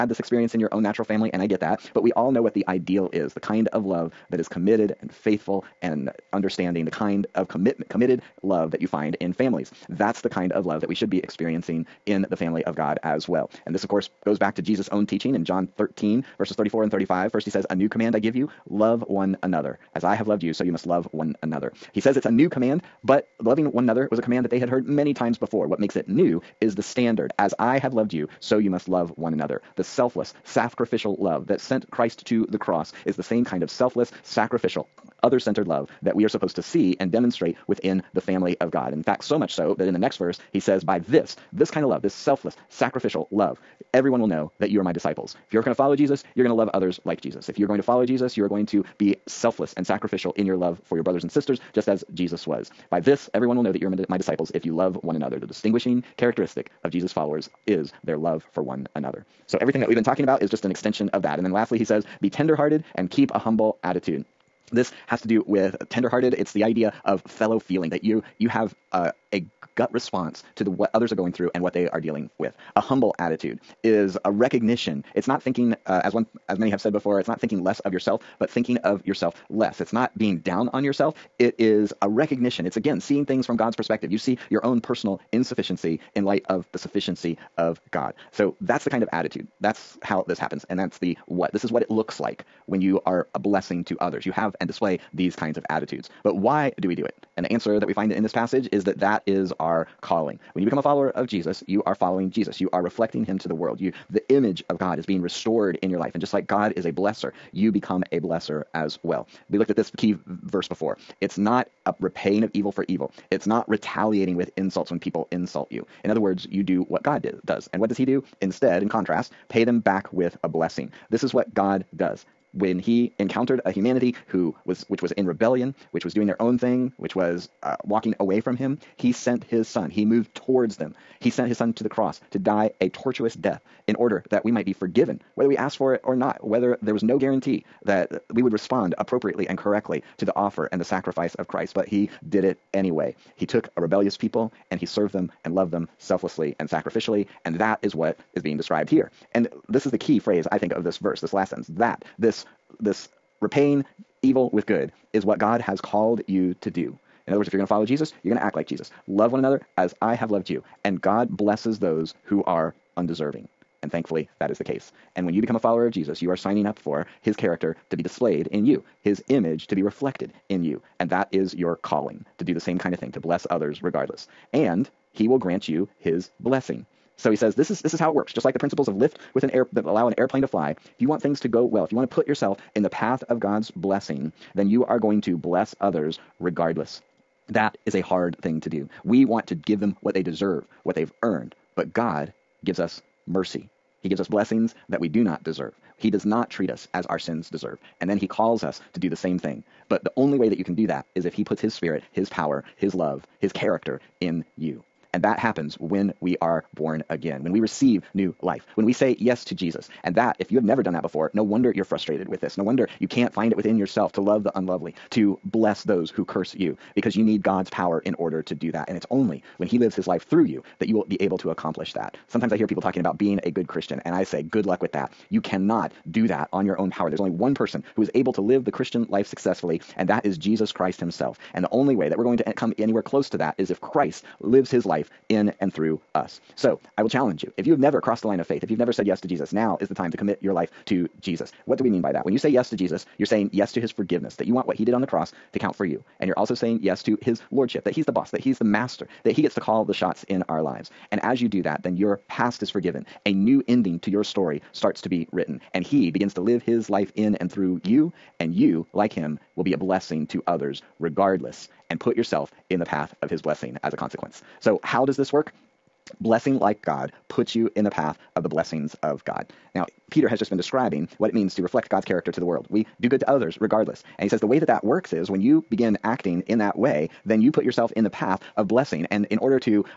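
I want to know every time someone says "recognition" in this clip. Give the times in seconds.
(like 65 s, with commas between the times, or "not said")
74 s, 82 s.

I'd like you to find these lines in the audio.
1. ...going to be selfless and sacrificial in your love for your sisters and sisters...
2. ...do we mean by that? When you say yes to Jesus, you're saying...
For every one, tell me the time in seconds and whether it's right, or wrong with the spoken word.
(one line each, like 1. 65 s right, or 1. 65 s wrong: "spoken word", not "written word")
1. 48 s wrong: "brothers", not "sisters"
2. 241 s right.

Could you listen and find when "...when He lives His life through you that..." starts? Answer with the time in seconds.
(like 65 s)
219 s.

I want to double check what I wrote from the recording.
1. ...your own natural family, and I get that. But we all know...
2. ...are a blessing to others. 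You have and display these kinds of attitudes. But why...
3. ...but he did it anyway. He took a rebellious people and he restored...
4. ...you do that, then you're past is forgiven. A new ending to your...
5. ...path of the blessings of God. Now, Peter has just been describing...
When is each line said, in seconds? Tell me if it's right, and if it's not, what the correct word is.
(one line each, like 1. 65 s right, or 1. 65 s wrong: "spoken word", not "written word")
1. 0 s right
2. 93 s right
3. 141 s wrong: "served", not "restored"
4. 251 s right
5. 267 s right.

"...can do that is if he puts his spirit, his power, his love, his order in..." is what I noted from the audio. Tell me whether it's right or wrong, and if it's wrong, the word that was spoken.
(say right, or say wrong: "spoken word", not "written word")
wrong: "character", not "order".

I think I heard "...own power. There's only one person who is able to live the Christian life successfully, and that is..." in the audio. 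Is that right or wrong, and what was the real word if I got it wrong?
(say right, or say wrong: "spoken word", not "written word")
right.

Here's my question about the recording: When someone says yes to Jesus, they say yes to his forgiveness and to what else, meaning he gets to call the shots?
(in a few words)
His lordship.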